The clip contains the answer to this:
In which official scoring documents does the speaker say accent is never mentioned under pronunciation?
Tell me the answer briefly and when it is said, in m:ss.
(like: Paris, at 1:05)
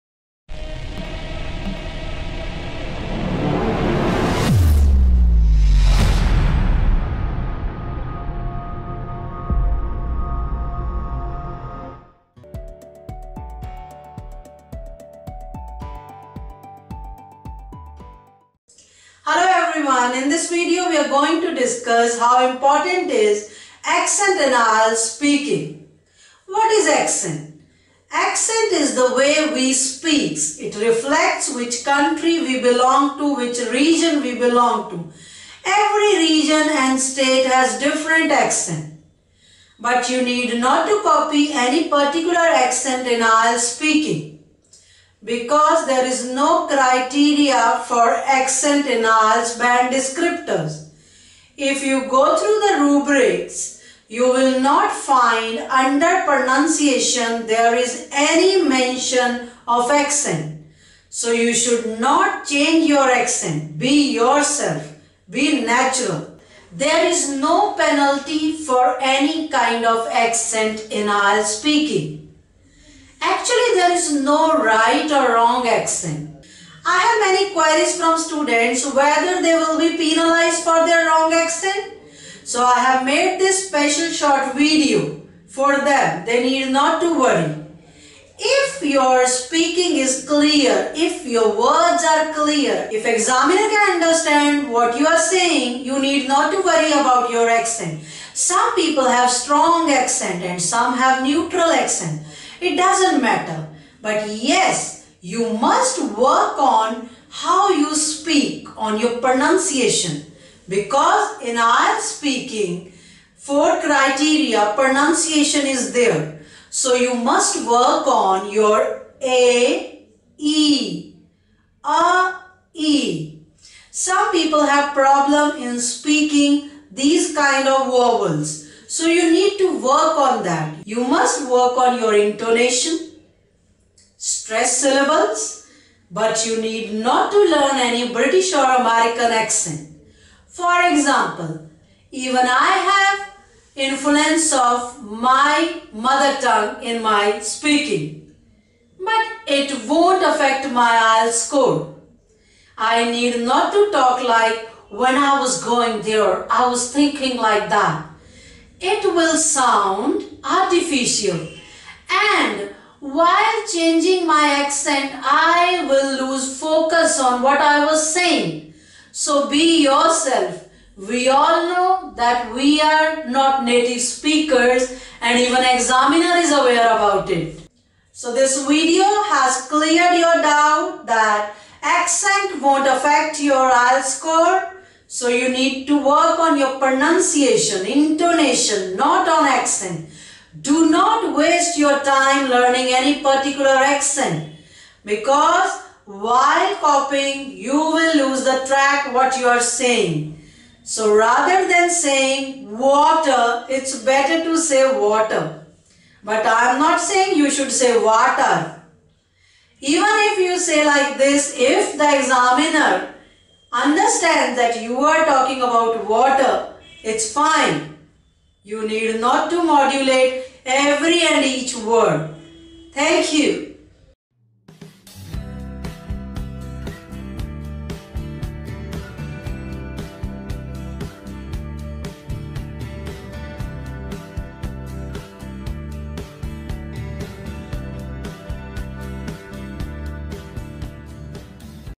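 the rubrics, at 0:52.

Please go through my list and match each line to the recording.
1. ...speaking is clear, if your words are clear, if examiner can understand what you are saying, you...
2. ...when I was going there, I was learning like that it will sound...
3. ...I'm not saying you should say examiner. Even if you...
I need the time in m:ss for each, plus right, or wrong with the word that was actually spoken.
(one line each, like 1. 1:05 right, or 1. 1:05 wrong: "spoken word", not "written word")
1. 1:29 right
2. 2:34 wrong: "thinking", not "learning"
3. 3:26 wrong: "water", not "examiner".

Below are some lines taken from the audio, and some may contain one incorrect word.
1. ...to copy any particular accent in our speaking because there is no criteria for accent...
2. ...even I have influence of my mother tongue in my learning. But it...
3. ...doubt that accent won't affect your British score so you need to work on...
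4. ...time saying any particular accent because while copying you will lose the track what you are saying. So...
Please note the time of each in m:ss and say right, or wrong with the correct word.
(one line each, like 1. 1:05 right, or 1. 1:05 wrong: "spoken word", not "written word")
1. 0:40 right
2. 2:22 wrong: "speaking", not "learning"
3. 3:00 wrong: "IELTS", not "British"
4. 3:11 wrong: "learning", not "saying".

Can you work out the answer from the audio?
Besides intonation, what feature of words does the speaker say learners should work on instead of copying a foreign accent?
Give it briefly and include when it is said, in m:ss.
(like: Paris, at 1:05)
stress syllables, at 2:14.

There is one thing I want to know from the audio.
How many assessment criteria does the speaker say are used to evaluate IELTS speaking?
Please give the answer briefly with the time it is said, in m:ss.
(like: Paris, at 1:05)
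4, at 1:53.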